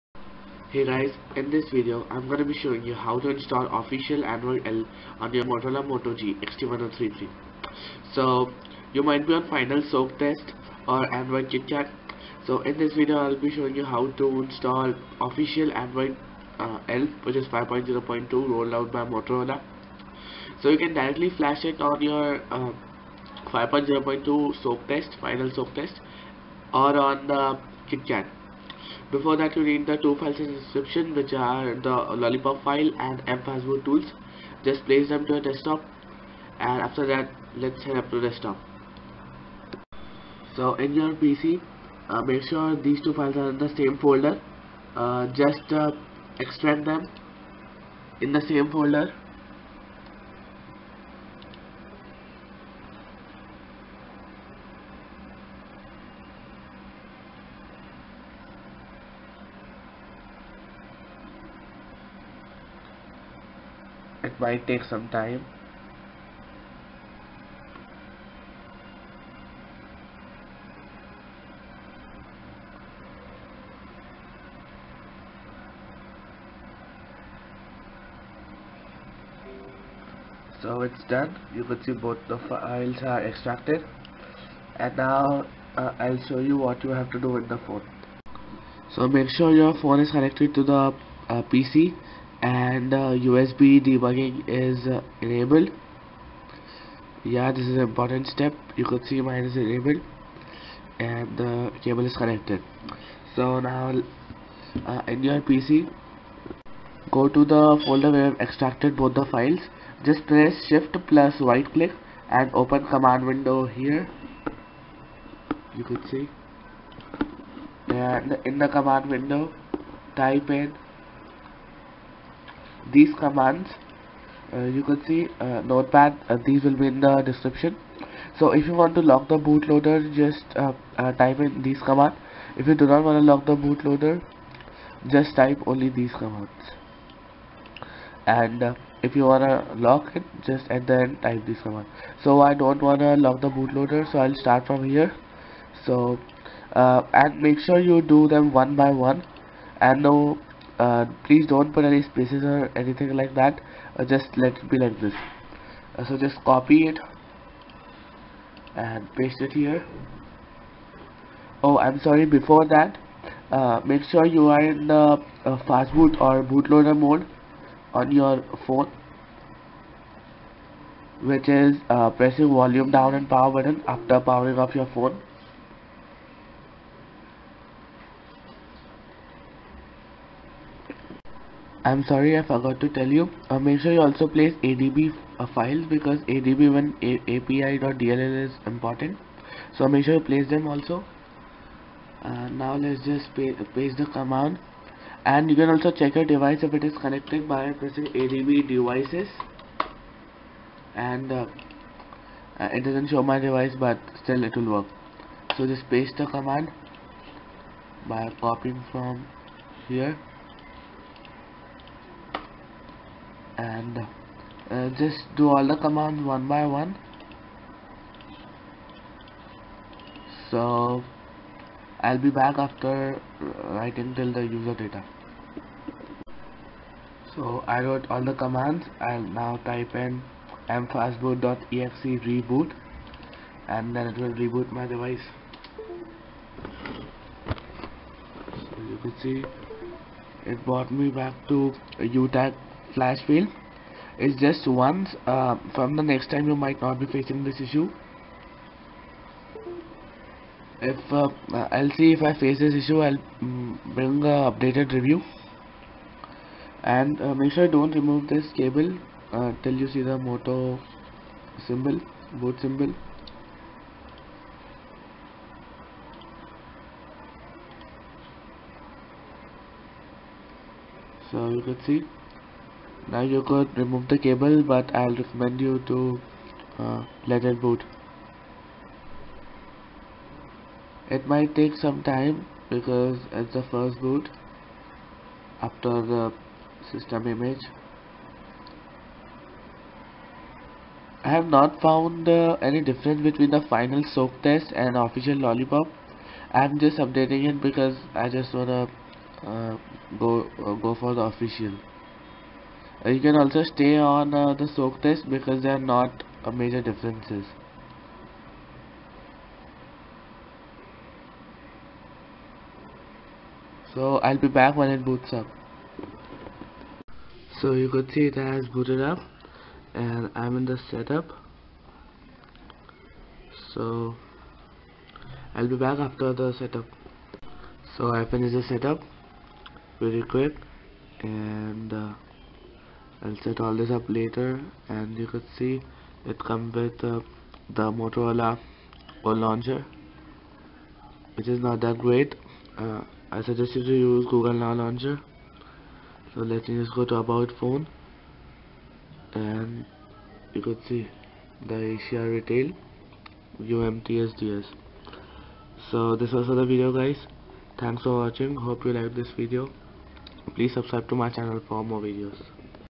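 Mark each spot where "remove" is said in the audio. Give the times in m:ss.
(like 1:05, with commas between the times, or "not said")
4:17, 4:33.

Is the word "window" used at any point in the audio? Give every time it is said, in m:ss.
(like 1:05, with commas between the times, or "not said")
1:53, 1:59.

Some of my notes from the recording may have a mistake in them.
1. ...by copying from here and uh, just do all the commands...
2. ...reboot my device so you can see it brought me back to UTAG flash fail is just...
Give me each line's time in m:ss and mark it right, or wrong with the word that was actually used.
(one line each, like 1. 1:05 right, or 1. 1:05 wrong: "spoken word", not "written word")
1. 3:28 right
2. 3:54 right.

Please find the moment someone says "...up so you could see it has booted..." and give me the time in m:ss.
5:15.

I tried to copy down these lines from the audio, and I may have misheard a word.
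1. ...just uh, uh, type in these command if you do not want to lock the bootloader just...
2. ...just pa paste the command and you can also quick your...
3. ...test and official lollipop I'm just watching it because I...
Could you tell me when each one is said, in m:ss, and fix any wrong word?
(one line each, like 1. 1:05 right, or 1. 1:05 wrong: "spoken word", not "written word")
1. 2:10 right
2. 3:13 wrong: "check", not "quick"
3. 4:54 wrong: "updating", not "watching".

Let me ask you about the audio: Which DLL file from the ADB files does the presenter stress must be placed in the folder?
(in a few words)
ADB1 API.dll.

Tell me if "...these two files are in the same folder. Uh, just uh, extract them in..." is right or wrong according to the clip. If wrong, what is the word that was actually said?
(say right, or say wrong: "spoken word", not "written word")
right.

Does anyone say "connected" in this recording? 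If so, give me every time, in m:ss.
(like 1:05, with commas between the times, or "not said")
1:30, 1:42, 3:17.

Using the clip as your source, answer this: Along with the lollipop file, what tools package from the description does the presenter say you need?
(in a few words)
mfastboot tools.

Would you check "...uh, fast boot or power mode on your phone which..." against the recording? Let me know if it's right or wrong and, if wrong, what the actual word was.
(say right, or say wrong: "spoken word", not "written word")
wrong: "bootloader", not "power".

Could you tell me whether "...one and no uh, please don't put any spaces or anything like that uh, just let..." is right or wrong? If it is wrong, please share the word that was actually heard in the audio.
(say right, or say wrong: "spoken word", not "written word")
right.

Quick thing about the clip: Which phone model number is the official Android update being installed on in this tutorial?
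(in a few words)
XT1033.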